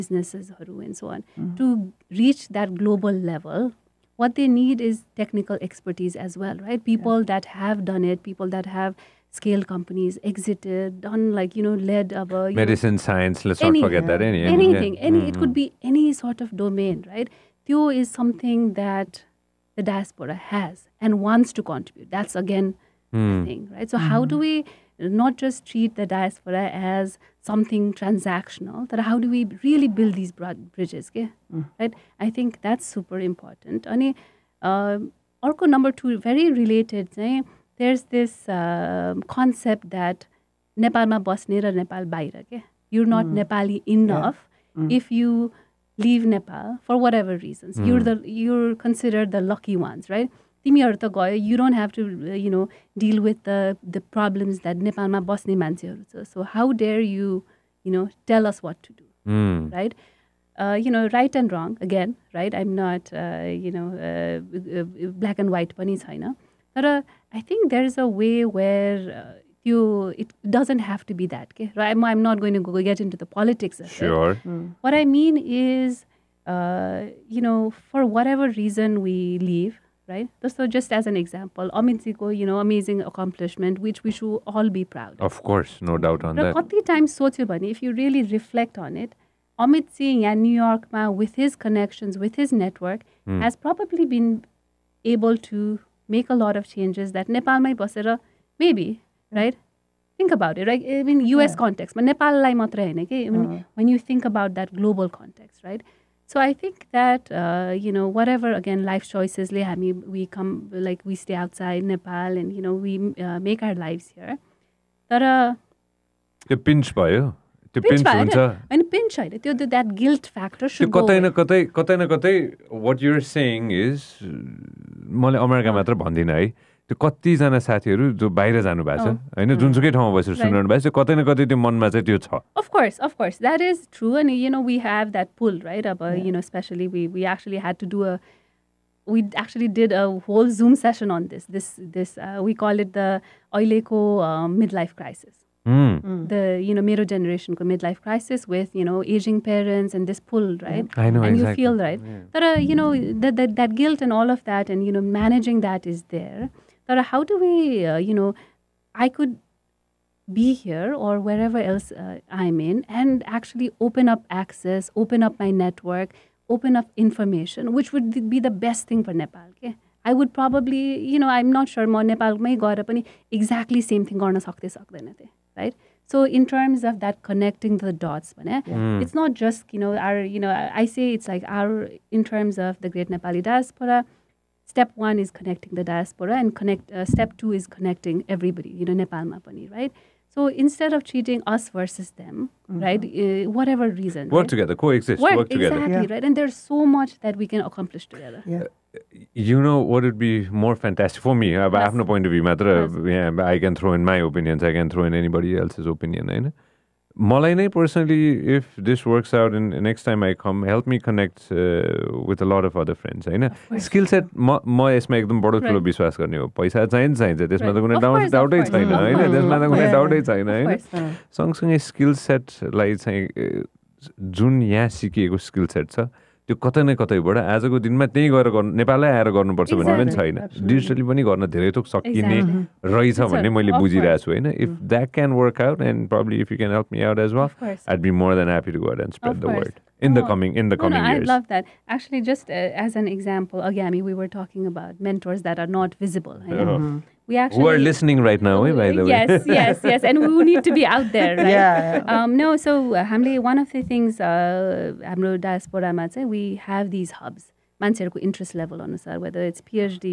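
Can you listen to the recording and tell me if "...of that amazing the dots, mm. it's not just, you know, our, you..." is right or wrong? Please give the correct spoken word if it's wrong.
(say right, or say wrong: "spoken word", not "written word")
wrong: "connecting", not "amazing".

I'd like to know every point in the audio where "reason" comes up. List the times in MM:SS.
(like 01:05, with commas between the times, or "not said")
01:18, 03:14.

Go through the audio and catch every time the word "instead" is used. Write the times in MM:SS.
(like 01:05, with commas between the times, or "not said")
03:10.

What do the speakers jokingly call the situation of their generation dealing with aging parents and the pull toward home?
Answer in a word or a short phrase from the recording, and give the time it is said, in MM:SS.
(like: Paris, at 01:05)
midlife crisis, at 02:24.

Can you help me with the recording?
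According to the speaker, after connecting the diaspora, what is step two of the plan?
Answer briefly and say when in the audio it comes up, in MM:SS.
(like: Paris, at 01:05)
connecting everybody, at 03:07.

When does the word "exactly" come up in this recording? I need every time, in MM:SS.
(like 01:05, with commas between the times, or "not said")
02:31, 02:53, 03:15.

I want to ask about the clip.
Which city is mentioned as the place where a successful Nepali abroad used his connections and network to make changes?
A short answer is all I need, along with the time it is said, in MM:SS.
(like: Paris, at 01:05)
New York, at 01:30.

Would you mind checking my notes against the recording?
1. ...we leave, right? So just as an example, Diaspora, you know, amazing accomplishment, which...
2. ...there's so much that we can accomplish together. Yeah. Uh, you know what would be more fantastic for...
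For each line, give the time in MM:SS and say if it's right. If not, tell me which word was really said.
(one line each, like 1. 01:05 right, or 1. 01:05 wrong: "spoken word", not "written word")
1. 01:19 wrong: "Amintsiko", not "Diaspora"
2. 03:16 right.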